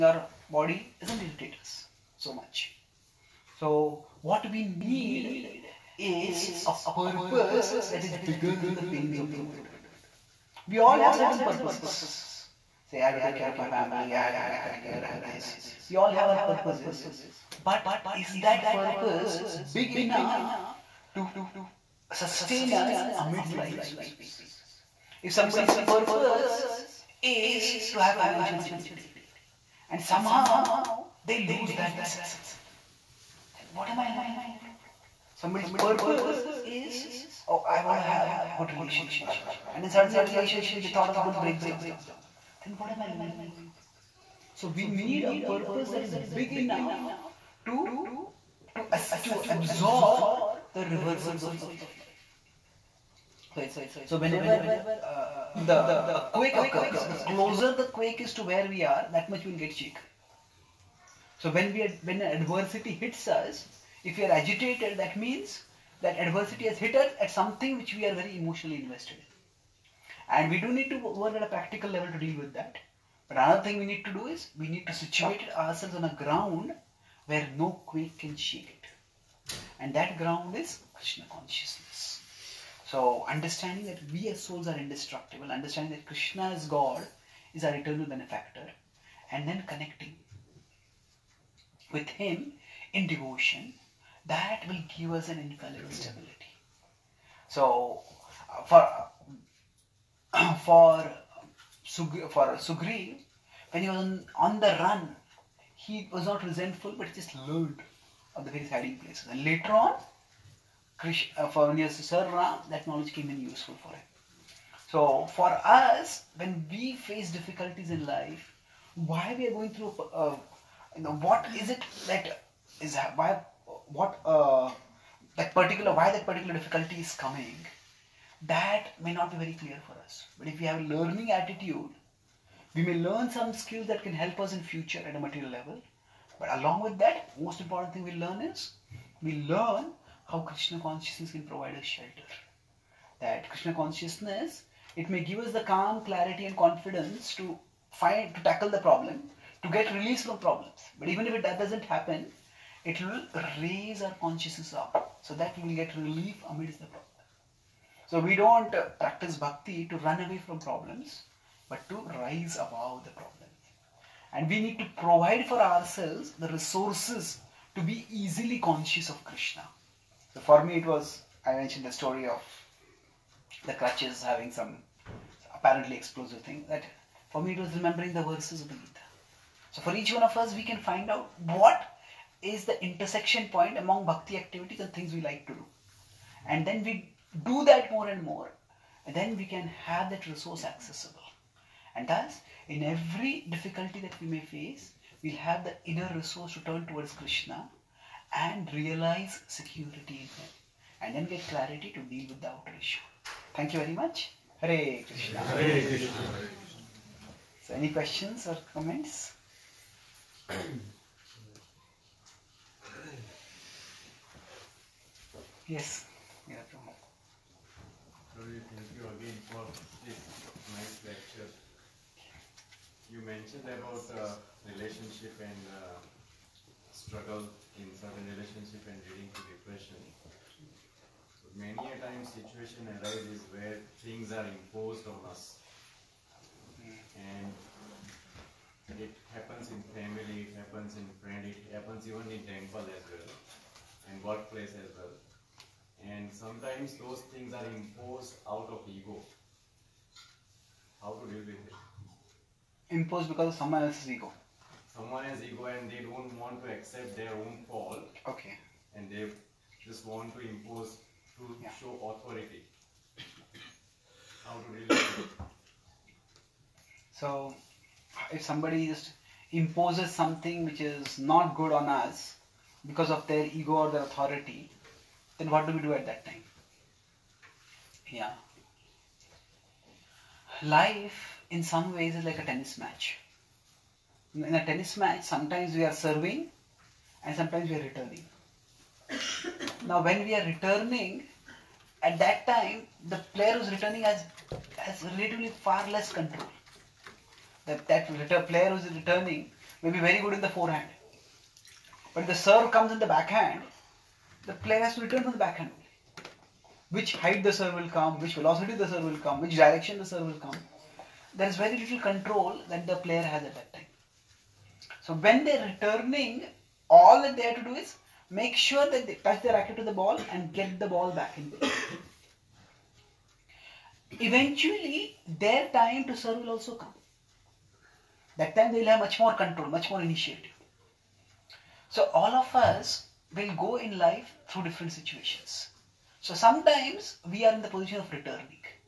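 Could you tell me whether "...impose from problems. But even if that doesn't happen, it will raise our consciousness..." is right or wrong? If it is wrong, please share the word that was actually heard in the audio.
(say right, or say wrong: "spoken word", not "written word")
wrong: "release", not "impose".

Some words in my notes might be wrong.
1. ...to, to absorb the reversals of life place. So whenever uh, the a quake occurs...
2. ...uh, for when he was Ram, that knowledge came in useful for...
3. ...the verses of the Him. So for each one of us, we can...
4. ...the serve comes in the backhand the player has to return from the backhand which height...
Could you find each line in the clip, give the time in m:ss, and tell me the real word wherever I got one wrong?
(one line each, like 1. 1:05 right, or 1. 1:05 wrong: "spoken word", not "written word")
1. 0:48 right
2. 1:51 right
3. 2:58 wrong: "Gita", not "Him"
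4. 5:02 right.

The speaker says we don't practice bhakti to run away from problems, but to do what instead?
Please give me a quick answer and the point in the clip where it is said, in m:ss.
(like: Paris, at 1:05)
Rise above the problems, at 2:42.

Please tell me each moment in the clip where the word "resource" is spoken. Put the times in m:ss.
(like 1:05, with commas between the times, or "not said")
2:46, 3:10, 3:16.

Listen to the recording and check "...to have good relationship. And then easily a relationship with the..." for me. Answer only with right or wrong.
wrong.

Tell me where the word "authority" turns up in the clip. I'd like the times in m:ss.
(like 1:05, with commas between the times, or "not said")
4:22, 4:34.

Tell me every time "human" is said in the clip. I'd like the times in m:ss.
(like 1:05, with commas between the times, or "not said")
not said.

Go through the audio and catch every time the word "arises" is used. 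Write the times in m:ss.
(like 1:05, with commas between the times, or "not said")
3:52.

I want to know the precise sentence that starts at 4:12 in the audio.
Imposed because of someone else's ego someone has ego and they don't want to accept their own fall.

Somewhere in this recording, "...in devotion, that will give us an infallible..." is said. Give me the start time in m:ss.
1:32.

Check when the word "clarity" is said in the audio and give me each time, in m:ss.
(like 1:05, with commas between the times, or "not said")
2:26, 3:21.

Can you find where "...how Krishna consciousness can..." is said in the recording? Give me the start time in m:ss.
2:20.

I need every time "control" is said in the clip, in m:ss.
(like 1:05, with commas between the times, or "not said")
4:56, 5:12, 5:29.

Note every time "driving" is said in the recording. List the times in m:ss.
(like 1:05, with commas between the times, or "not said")
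not said.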